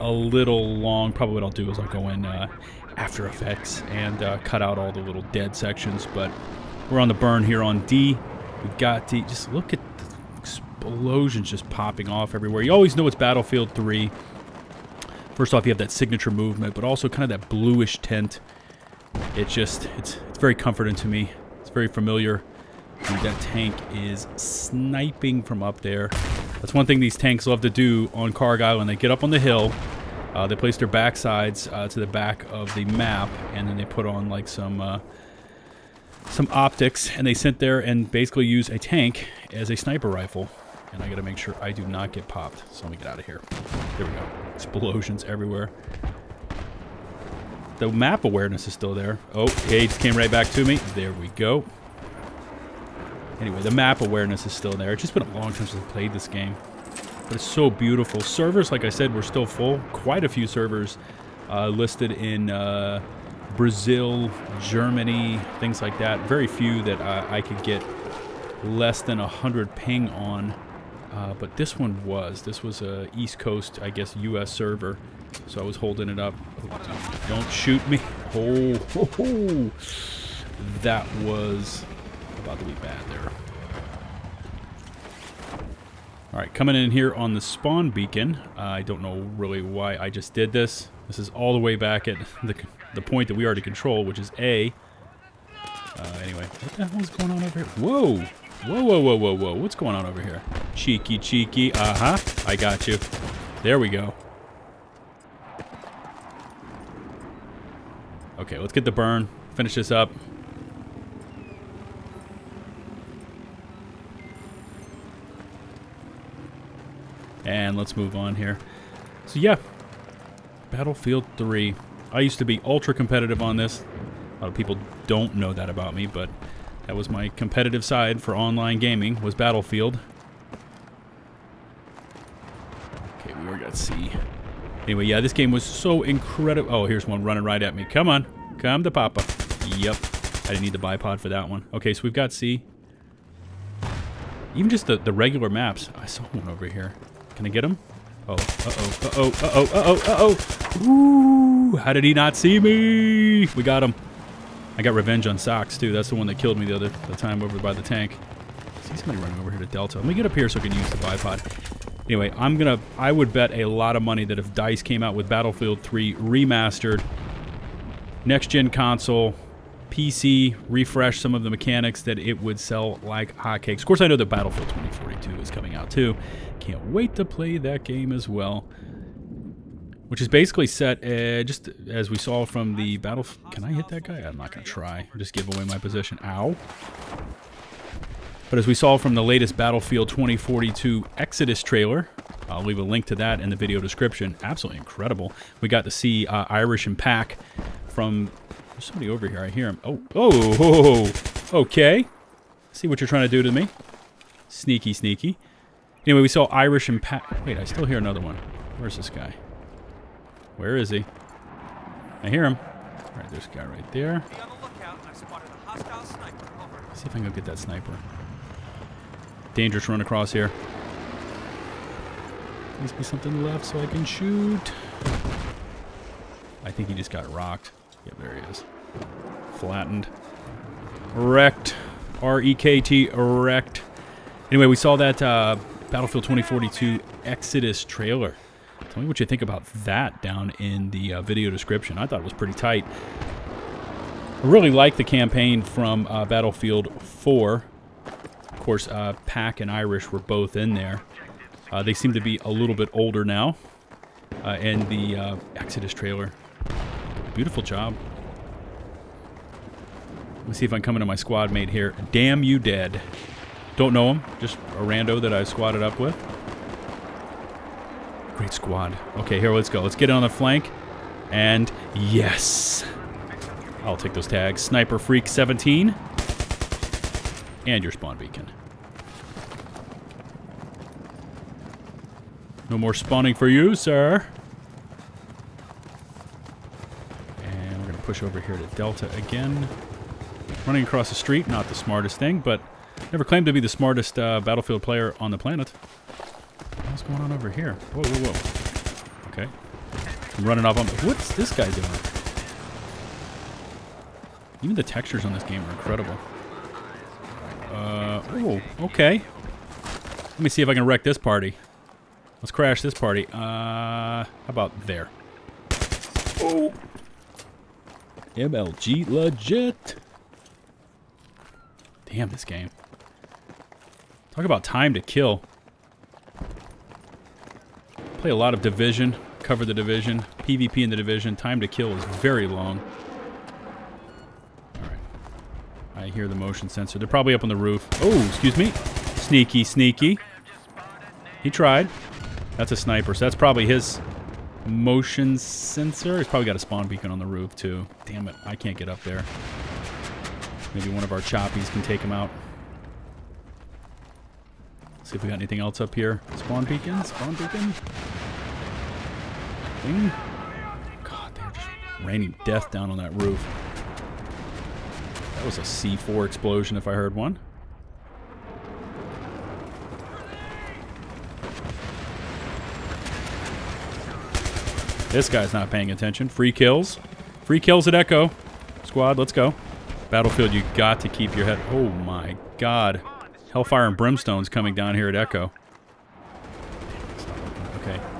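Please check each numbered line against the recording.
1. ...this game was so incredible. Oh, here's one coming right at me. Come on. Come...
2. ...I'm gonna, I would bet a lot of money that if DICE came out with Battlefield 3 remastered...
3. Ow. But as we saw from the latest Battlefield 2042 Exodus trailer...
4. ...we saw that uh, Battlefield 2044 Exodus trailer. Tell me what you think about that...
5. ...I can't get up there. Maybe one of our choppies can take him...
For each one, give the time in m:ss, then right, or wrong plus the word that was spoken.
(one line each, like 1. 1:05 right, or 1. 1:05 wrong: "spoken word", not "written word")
1. 2:15 wrong: "running", not "coming"
2. 2:42 right
3. 3:06 right
4. 3:54 wrong: "2042", not "2044"
5. 5:48 right.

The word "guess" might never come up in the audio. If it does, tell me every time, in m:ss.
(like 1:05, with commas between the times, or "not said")
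1:13.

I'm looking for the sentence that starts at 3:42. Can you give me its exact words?
Please be something left so I can shoot.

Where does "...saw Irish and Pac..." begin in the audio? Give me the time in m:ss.
3:26.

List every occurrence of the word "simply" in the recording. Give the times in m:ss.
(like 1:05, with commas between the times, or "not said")
not said.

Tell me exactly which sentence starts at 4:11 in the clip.
Uh, they seem to be a little bit older now.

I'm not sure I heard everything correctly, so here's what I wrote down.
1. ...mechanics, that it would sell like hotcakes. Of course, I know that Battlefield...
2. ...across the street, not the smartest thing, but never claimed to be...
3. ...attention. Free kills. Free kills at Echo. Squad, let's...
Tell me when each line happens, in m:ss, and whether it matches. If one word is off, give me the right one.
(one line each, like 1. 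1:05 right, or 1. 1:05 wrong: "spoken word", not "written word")
1. 2:51 right
2. 4:50 right
3. 6:15 right.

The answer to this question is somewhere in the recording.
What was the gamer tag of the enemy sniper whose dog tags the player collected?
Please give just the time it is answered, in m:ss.
4:34.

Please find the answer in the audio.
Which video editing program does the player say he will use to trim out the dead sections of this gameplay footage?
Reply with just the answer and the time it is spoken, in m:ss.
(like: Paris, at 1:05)
After Effects, at 0:02.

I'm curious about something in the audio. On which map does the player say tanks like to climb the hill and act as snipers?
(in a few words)
Cargill.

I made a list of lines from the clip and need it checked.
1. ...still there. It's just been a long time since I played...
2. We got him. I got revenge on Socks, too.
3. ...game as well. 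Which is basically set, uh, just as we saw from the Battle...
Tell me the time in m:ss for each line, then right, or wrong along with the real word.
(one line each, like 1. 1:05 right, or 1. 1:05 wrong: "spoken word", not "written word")
1. 0:54 right
2. 2:33 right
3. 2:57 right.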